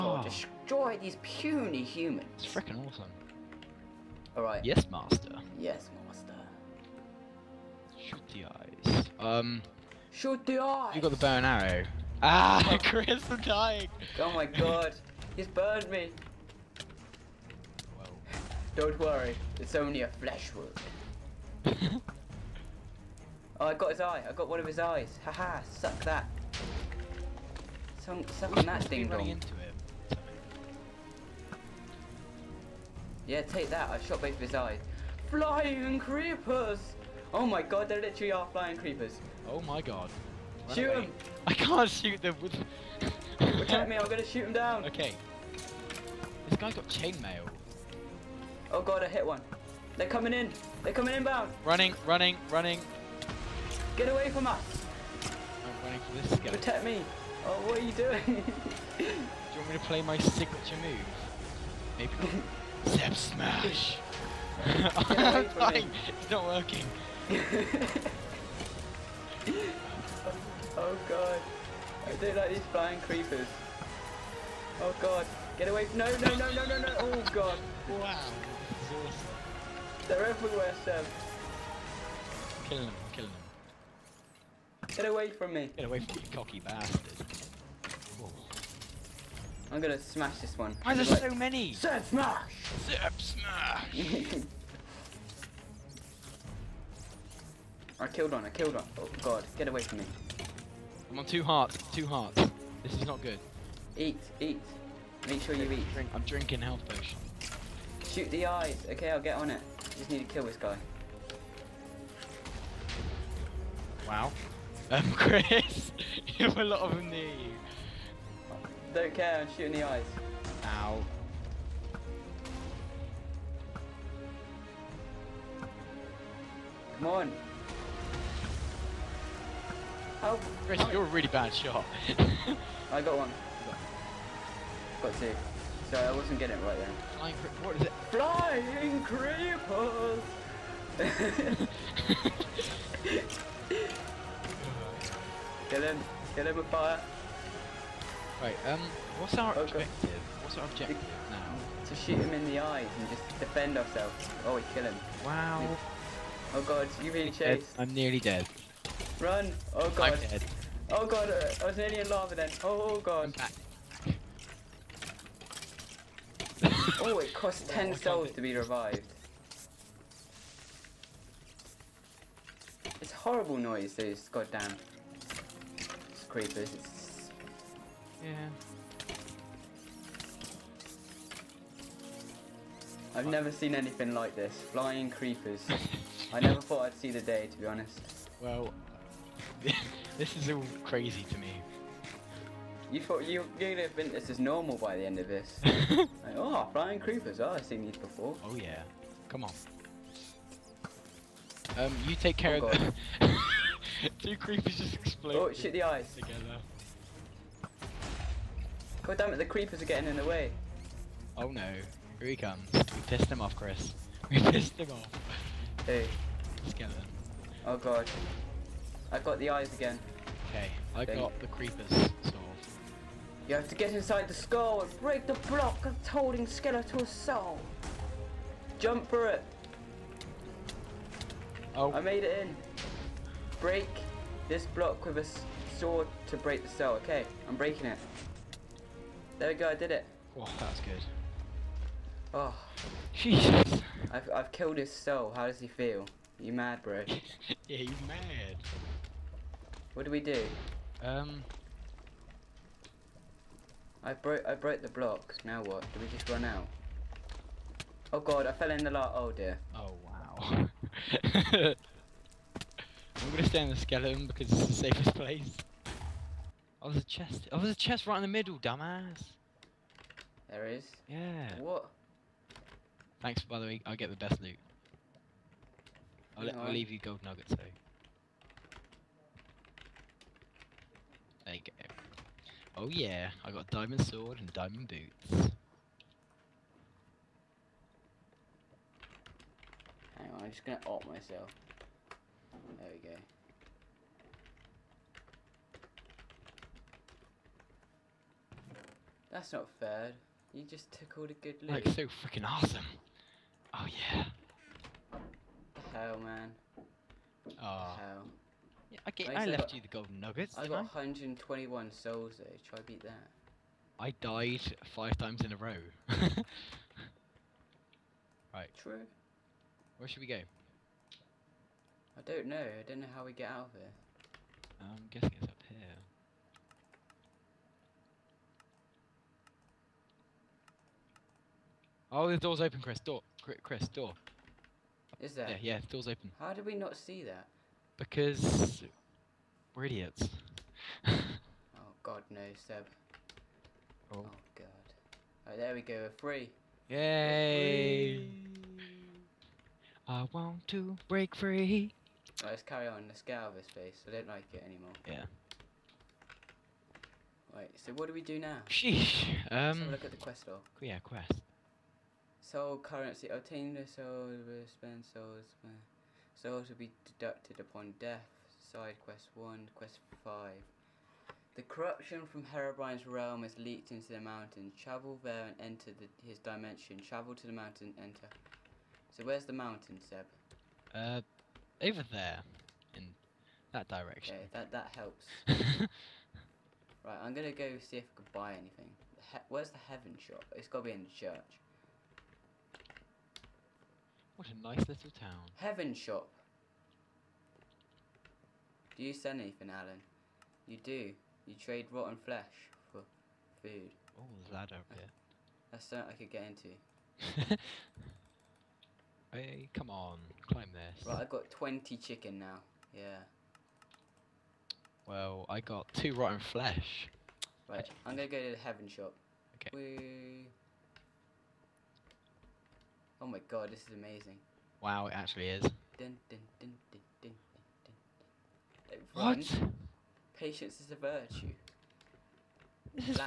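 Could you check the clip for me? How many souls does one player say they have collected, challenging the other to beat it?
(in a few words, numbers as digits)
121.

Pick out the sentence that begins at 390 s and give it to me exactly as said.
It's gotta be in the church.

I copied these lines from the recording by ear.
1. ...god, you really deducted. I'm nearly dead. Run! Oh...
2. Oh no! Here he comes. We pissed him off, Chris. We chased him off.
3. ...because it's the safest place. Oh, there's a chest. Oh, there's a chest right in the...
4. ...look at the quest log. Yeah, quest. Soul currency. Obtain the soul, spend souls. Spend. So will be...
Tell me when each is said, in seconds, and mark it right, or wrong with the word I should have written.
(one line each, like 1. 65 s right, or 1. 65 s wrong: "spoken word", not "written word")
1. 156 s wrong: "chased", not "deducted"
2. 211 s wrong: "pissed", not "chased"
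3. 264 s right
4. 359 s right.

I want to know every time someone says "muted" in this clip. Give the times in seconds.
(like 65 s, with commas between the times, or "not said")
not said.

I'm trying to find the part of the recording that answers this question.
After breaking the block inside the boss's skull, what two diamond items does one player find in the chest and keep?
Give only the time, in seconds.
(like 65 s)
283 s.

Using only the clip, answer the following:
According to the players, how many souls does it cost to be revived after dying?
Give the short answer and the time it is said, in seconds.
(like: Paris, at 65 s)
10, at 167 s.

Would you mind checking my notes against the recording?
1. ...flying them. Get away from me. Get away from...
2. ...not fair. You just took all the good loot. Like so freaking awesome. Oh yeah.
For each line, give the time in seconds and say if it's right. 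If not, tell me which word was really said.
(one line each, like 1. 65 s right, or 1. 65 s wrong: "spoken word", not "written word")
1. 83 s wrong: "killing", not "flying"
2. 299 s right.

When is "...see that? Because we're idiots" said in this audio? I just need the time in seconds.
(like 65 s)
336 s.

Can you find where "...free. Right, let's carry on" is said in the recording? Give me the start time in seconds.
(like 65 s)
351 s.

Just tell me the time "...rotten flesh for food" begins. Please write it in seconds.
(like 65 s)
401 s.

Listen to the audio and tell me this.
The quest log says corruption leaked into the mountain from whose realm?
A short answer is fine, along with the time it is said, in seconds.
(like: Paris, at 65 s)
Herobrine's, at 372 s.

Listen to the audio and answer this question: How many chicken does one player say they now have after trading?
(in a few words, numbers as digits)
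20.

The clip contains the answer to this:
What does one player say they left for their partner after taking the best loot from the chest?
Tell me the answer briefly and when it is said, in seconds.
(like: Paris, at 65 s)
Gold nuggets, at 276 s.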